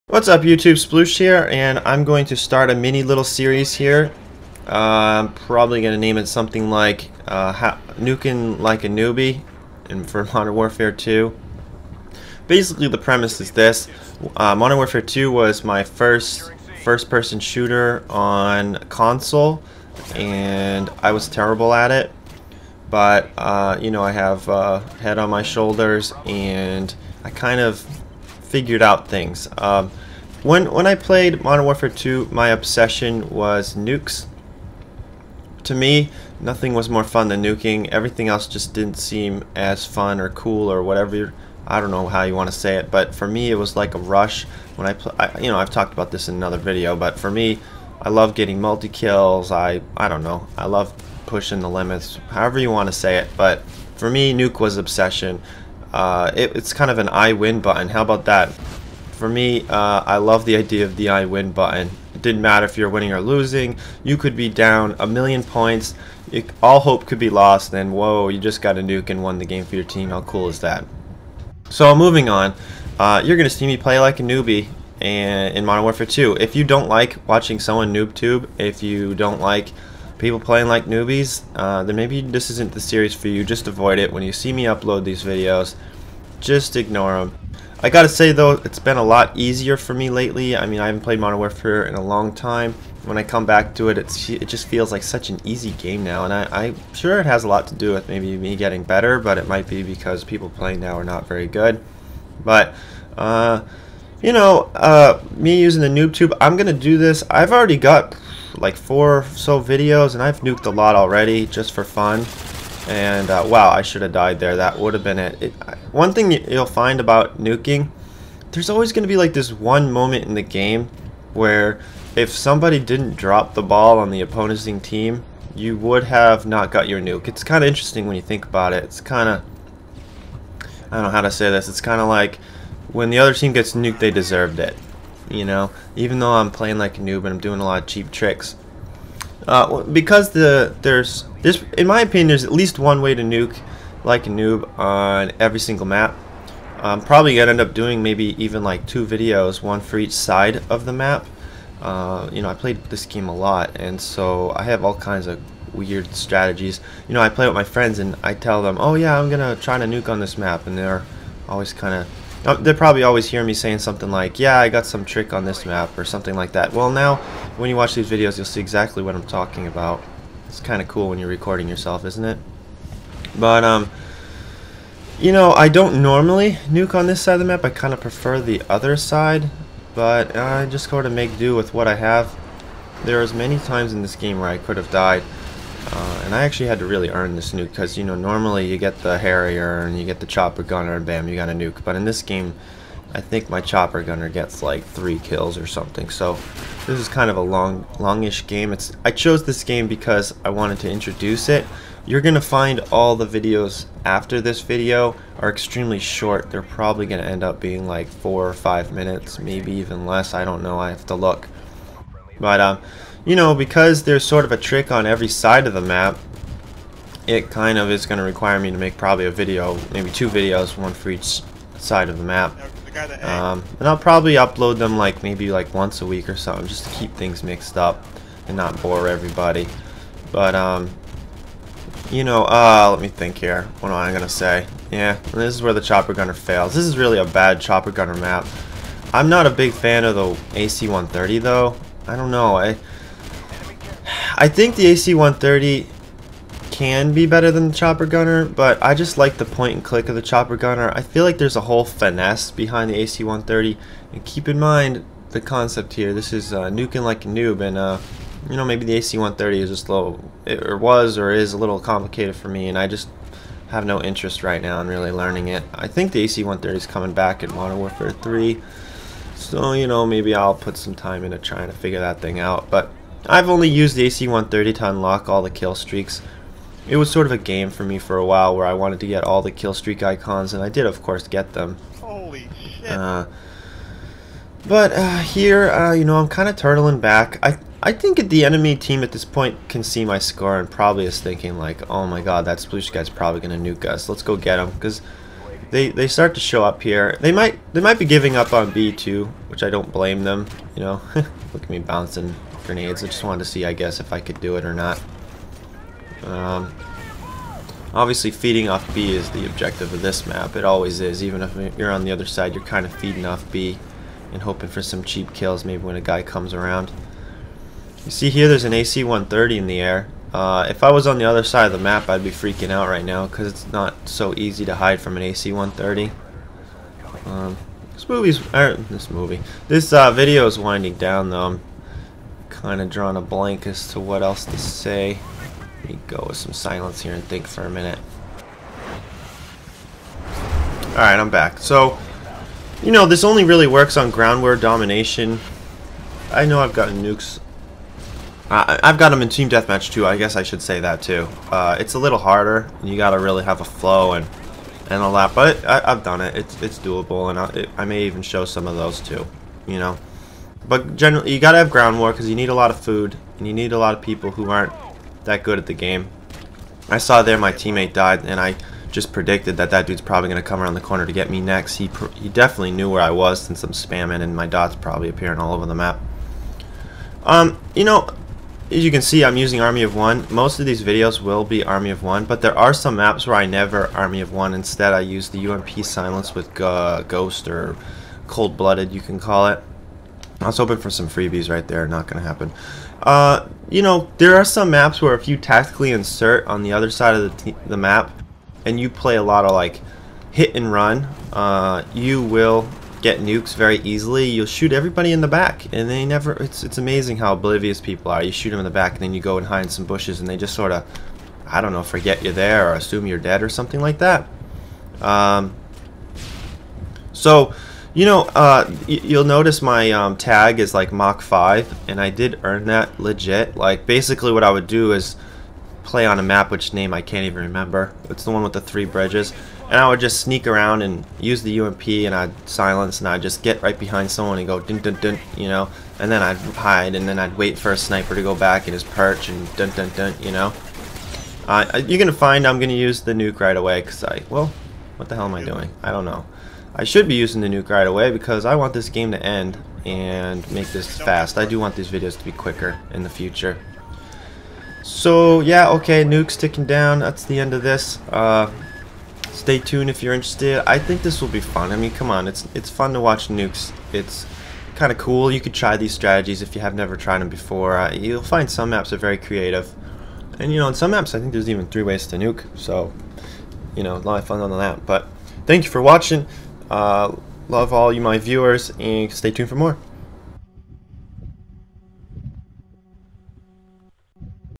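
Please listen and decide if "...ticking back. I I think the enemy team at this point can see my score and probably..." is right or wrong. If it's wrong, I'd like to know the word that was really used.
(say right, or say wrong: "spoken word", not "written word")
wrong: "turtling", not "ticking".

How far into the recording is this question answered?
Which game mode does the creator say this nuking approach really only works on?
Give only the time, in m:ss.
5:44.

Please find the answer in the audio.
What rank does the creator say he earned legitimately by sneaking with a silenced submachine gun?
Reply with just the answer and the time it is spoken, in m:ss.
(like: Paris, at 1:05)
Mach 5, at 7:00.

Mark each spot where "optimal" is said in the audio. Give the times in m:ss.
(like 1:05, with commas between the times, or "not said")
not said.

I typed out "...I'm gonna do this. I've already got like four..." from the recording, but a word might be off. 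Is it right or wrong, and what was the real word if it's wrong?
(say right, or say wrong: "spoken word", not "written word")
right.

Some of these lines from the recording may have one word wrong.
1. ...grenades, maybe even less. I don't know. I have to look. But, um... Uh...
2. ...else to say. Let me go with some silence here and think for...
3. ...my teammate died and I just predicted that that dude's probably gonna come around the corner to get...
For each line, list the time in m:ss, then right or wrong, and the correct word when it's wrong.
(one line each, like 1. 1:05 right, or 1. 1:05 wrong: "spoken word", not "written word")
1. 3:28 wrong: "minutes", not "grenades"
2. 5:34 right
3. 6:07 right.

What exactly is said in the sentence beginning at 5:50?
I guess I should say that too.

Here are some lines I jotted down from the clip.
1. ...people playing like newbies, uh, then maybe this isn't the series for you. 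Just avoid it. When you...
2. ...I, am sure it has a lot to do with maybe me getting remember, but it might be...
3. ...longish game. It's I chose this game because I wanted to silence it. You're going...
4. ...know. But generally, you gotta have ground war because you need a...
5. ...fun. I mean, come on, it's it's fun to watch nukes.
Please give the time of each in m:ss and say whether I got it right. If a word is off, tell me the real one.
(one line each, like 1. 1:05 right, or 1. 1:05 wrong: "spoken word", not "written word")
1. 1:20 right
2. 1:36 wrong: "better", not "remember"
3. 3:17 wrong: "introduce", not "silence"
4. 5:59 right
5. 7:41 right.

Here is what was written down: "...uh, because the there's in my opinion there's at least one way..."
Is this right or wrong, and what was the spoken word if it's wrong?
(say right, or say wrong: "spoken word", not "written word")
right.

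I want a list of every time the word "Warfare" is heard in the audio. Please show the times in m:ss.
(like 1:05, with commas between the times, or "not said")
0:10, 0:14, 0:31, 1:15, 1:31, 4:27.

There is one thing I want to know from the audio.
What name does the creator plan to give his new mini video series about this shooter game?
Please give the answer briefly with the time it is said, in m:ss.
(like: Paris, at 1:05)
Nuking Like a Newbie, at 0:07.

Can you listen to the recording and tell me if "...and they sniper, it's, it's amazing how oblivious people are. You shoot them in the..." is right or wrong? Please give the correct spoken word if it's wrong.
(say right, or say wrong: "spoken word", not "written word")
wrong: "never", not "sniper".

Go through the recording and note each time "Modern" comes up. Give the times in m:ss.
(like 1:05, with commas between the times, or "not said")
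0:10, 0:14, 0:31, 1:15, 1:31, 4:27.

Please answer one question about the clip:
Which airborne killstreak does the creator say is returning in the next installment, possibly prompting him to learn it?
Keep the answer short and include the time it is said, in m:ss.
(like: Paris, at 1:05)
AC-130, at 4:26.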